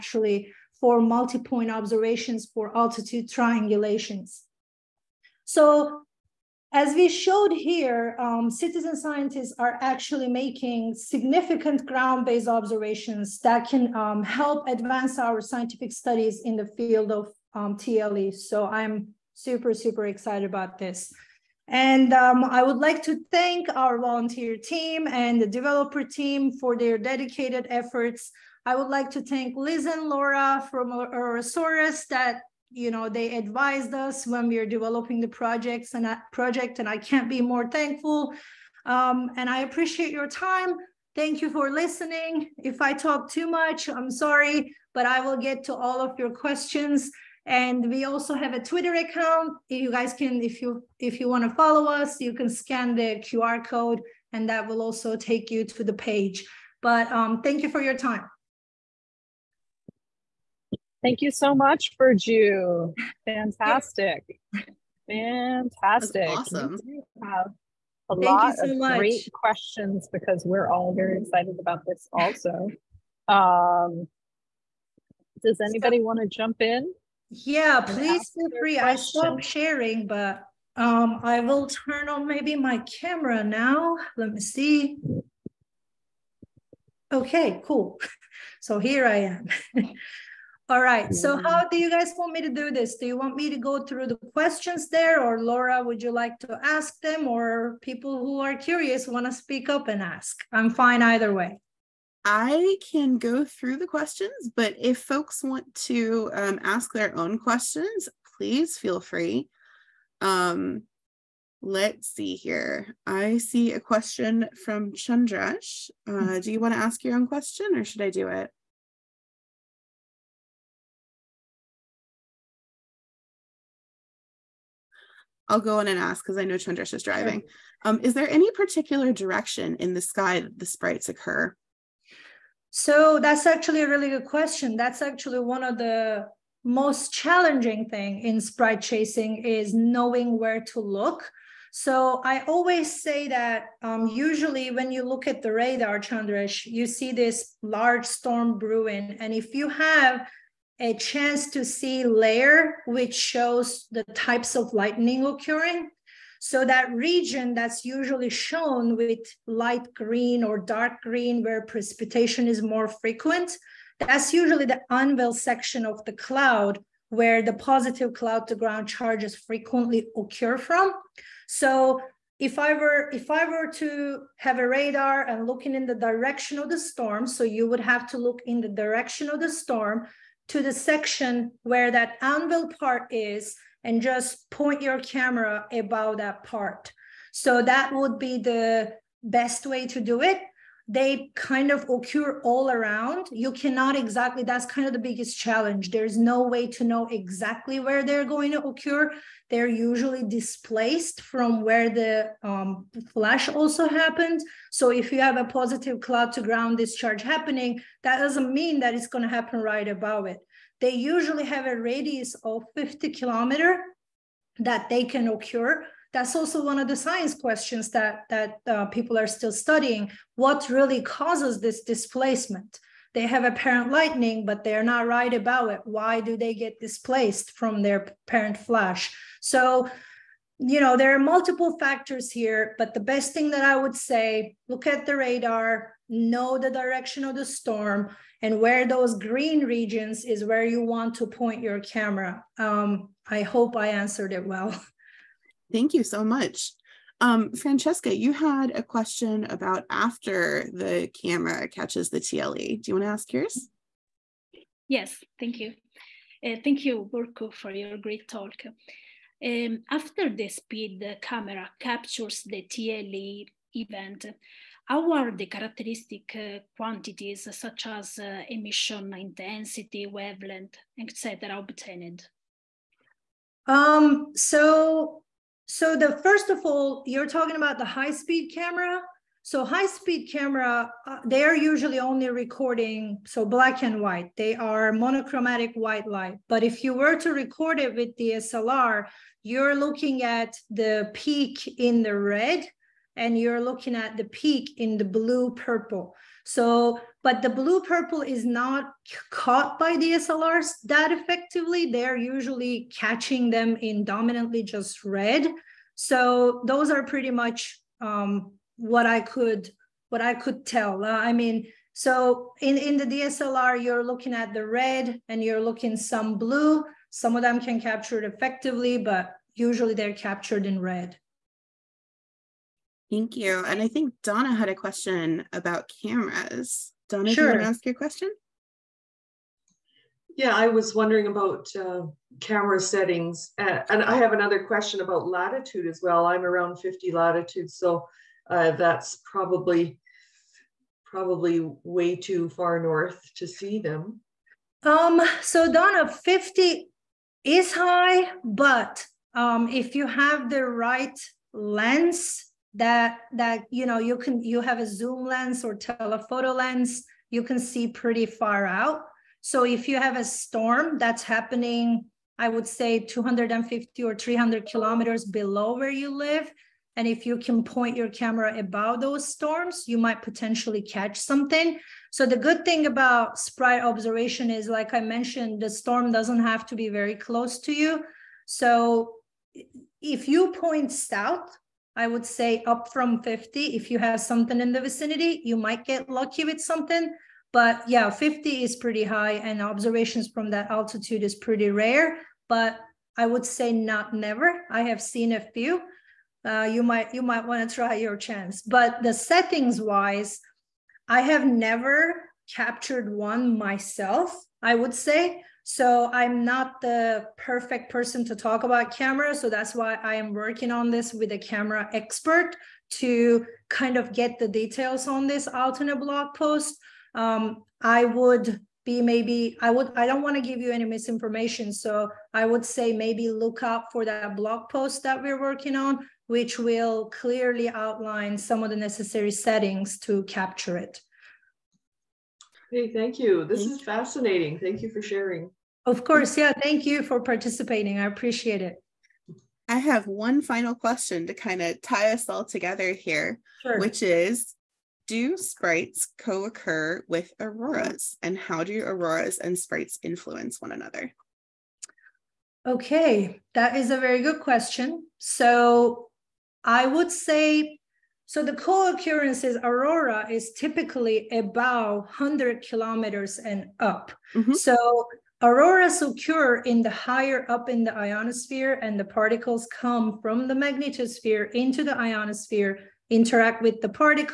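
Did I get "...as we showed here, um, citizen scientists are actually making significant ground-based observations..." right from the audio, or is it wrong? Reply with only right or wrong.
right.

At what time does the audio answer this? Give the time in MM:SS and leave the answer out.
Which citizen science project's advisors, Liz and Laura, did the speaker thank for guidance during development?
00:30.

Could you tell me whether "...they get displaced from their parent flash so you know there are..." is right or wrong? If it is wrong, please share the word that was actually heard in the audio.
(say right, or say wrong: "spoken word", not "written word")
right.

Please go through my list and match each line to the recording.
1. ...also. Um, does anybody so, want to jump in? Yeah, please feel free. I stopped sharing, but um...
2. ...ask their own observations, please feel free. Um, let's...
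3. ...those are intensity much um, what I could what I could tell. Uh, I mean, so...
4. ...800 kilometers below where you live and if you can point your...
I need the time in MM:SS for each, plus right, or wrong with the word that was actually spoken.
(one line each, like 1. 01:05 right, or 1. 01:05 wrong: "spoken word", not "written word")
1. 01:12 right
2. 01:46 wrong: "questions", not "observations"
3. 05:06 wrong: "pretty", not "intensity"
4. 06:04 wrong: "300", not "800".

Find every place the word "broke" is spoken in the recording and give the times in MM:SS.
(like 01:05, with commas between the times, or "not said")
not said.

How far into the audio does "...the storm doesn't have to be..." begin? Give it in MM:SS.
06:15.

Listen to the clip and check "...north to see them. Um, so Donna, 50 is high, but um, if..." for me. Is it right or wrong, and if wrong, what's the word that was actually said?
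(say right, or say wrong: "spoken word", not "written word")
right.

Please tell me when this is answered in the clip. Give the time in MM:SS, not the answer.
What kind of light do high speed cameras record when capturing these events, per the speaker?
04:44.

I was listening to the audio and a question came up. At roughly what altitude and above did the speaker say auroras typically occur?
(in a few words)
100 kilometers.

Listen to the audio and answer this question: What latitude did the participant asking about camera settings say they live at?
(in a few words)
50.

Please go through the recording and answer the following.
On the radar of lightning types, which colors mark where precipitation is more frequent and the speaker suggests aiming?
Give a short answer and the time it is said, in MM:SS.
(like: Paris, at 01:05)
light green or dark green, at 02:39.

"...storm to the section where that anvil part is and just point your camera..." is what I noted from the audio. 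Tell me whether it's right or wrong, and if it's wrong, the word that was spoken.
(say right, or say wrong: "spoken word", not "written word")
right.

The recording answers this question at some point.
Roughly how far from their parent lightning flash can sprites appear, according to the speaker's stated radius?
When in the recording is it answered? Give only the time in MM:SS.
03:32.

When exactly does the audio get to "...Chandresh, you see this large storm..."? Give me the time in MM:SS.
02:25.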